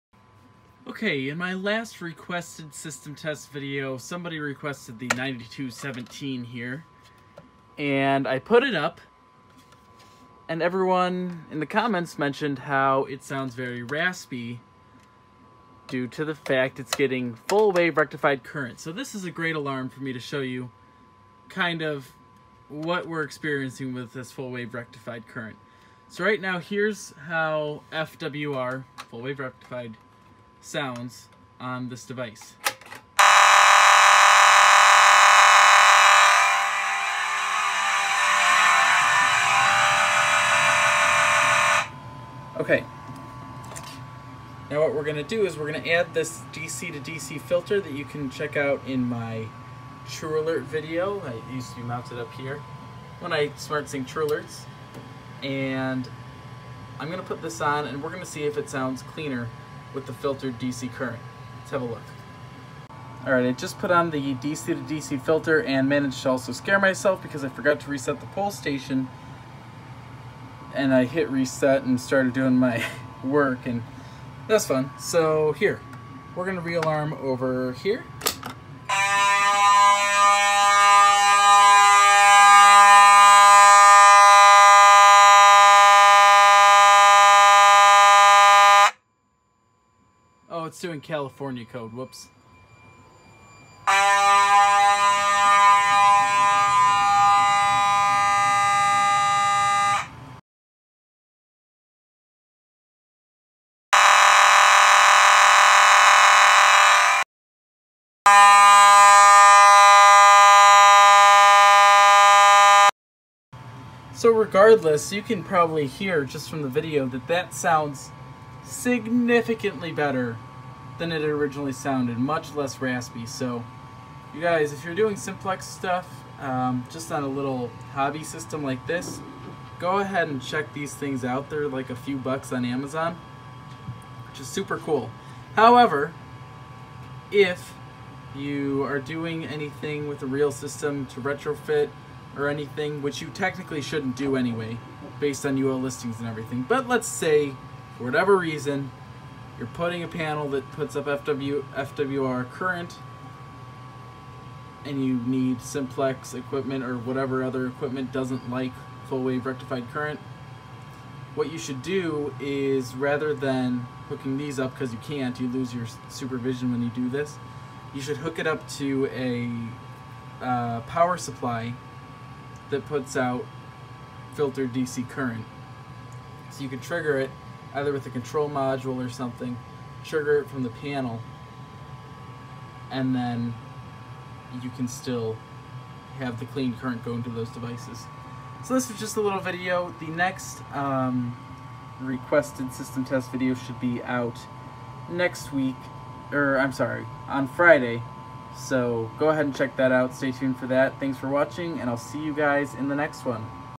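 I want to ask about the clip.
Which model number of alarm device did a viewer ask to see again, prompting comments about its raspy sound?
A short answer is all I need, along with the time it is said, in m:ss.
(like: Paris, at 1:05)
9217, at 0:05.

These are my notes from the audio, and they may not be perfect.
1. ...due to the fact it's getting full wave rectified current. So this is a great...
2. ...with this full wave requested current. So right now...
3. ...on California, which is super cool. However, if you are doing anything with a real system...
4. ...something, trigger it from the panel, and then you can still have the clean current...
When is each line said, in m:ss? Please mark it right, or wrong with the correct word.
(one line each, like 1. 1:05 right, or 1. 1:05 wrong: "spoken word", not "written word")
1. 0:15 right
2. 0:23 wrong: "rectified", not "requested"
3. 2:12 wrong: "Amazon", not "California"
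4. 2:59 right.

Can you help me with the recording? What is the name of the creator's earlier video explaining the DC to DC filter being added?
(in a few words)
True Alert video.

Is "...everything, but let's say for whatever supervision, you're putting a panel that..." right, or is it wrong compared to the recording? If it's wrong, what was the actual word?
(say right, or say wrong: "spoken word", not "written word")
wrong: "reason", not "supervision".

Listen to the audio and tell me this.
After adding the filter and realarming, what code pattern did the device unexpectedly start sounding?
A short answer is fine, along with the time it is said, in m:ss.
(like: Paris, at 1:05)
California code, at 1:30.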